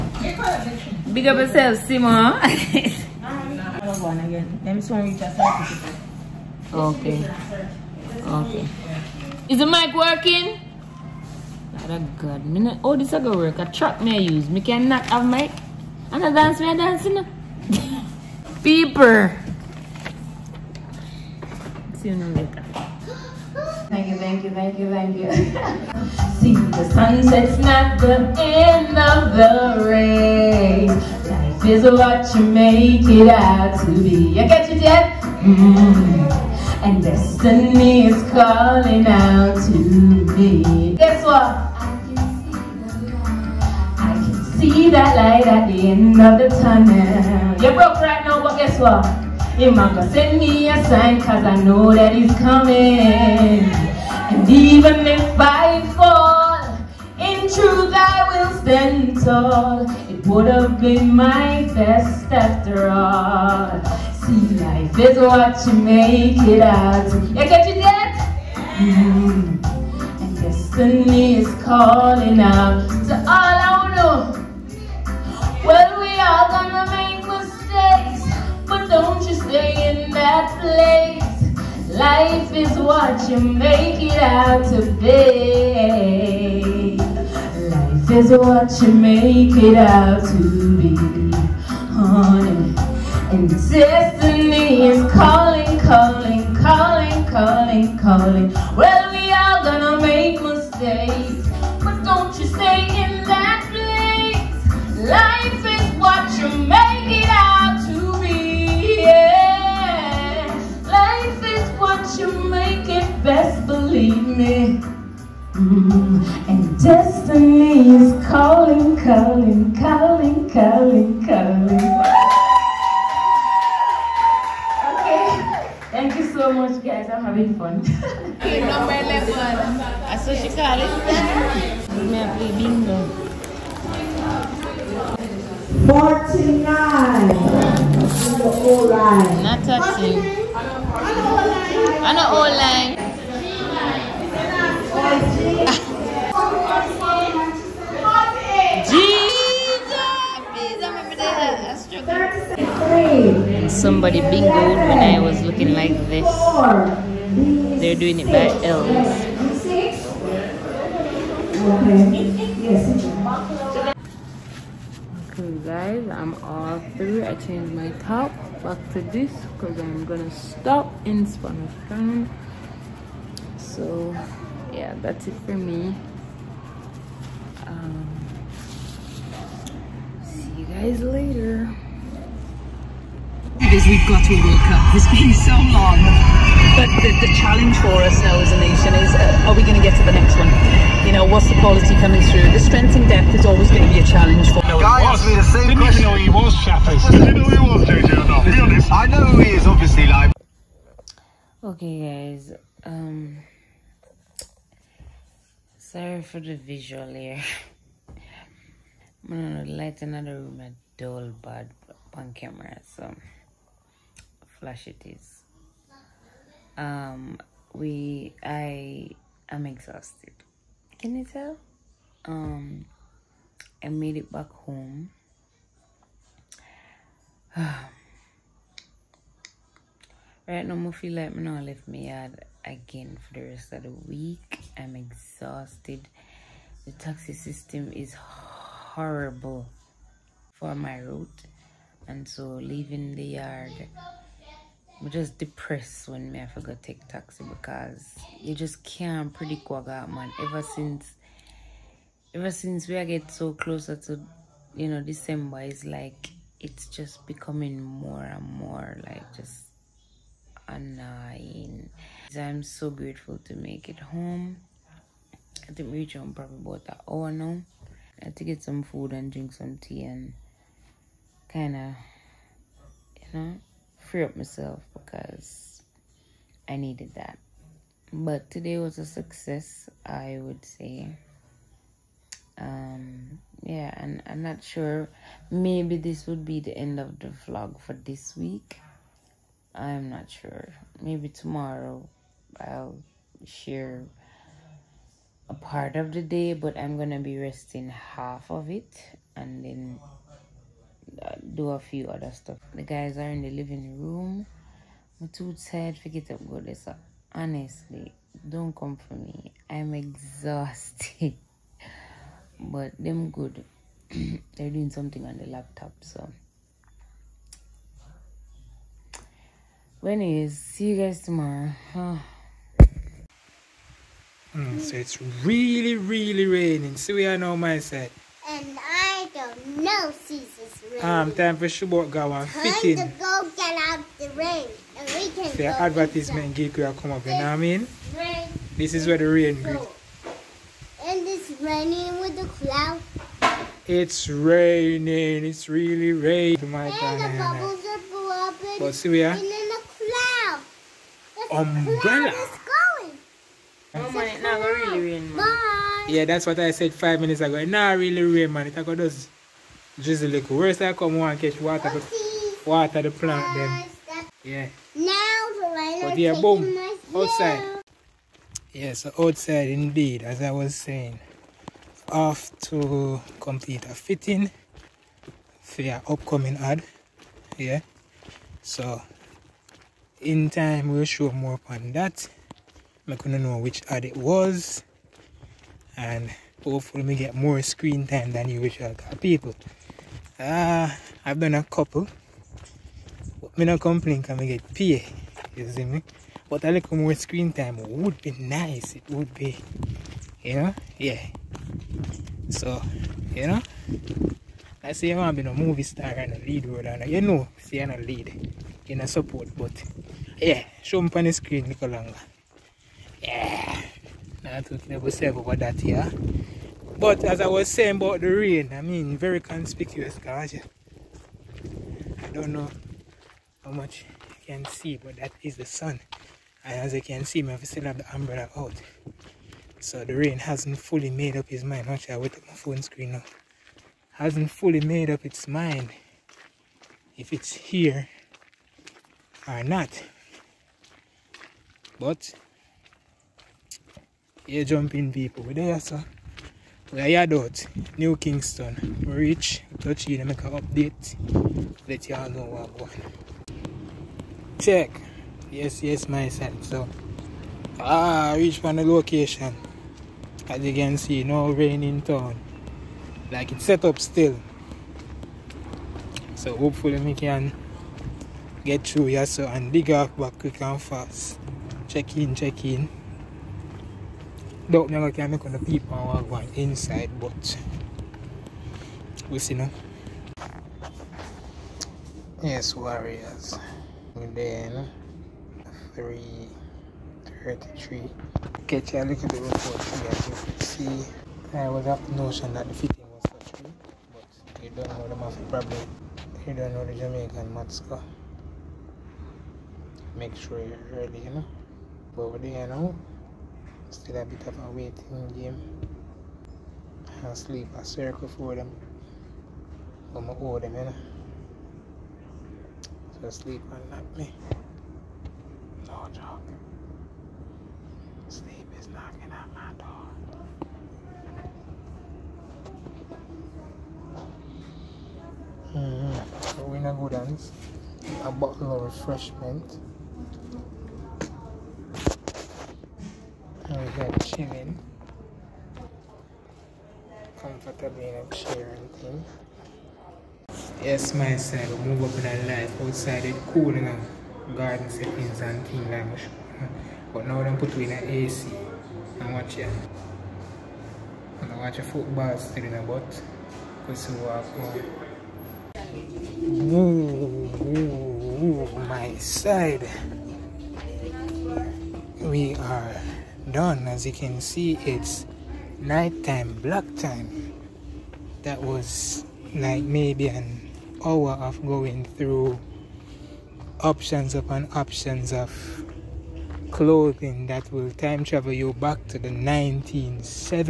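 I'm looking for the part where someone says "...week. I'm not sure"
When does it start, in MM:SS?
04:48.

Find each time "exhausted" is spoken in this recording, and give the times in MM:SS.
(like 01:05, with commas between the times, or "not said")
03:39, 03:54, 05:09.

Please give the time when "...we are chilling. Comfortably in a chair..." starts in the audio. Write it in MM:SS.
08:53.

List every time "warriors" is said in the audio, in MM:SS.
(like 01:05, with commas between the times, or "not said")
08:02.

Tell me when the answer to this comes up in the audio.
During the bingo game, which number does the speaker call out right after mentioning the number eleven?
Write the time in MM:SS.
02:15.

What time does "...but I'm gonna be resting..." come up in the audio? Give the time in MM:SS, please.
04:56.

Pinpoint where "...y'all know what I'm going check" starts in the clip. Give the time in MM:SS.
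07:32.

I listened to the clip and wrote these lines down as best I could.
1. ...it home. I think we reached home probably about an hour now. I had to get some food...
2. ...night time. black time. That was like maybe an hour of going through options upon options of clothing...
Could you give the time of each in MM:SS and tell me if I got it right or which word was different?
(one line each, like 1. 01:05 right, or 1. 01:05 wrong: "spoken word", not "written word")
1. 04:23 right
2. 09:25 right.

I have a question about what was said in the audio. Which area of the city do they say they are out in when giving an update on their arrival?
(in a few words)
New Kingston.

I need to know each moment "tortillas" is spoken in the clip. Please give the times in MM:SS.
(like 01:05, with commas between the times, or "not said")
not said.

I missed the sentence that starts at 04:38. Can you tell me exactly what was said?
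But today was a success, I would say.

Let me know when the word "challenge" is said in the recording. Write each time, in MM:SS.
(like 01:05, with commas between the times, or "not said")
03:07, 03:14.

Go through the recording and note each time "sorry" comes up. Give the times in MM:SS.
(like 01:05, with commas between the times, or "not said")
03:25.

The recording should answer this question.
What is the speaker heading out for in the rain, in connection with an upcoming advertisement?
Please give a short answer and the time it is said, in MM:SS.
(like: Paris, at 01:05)
a fitting, at 06:13.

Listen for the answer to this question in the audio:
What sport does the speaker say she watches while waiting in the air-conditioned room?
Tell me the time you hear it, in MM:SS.
09:11.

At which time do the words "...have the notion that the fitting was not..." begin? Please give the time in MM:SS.
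08:11.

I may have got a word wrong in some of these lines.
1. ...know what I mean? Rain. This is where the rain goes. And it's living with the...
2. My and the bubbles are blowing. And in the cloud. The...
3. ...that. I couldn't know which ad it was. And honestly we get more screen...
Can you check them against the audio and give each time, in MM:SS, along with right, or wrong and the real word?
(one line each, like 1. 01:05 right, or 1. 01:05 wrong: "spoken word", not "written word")
1. 05:37 wrong: "raining", not "living"
2. 05:46 right
3. 06:21 wrong: "hopefully", not "honestly".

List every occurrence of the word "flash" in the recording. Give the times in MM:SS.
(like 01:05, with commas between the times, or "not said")
03:34.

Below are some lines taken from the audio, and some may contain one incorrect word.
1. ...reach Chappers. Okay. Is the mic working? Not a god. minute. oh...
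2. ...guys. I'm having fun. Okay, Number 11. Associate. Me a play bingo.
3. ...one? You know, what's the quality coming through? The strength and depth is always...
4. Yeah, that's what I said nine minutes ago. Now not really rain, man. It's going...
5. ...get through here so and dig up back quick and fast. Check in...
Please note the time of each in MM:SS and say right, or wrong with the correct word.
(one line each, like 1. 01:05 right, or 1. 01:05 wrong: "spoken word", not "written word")
1. 00:05 wrong: "Okay", not "Chappers"
2. 02:06 right
3. 03:10 right
4. 05:56 wrong: "five", not "nine"
5. 07:48 right.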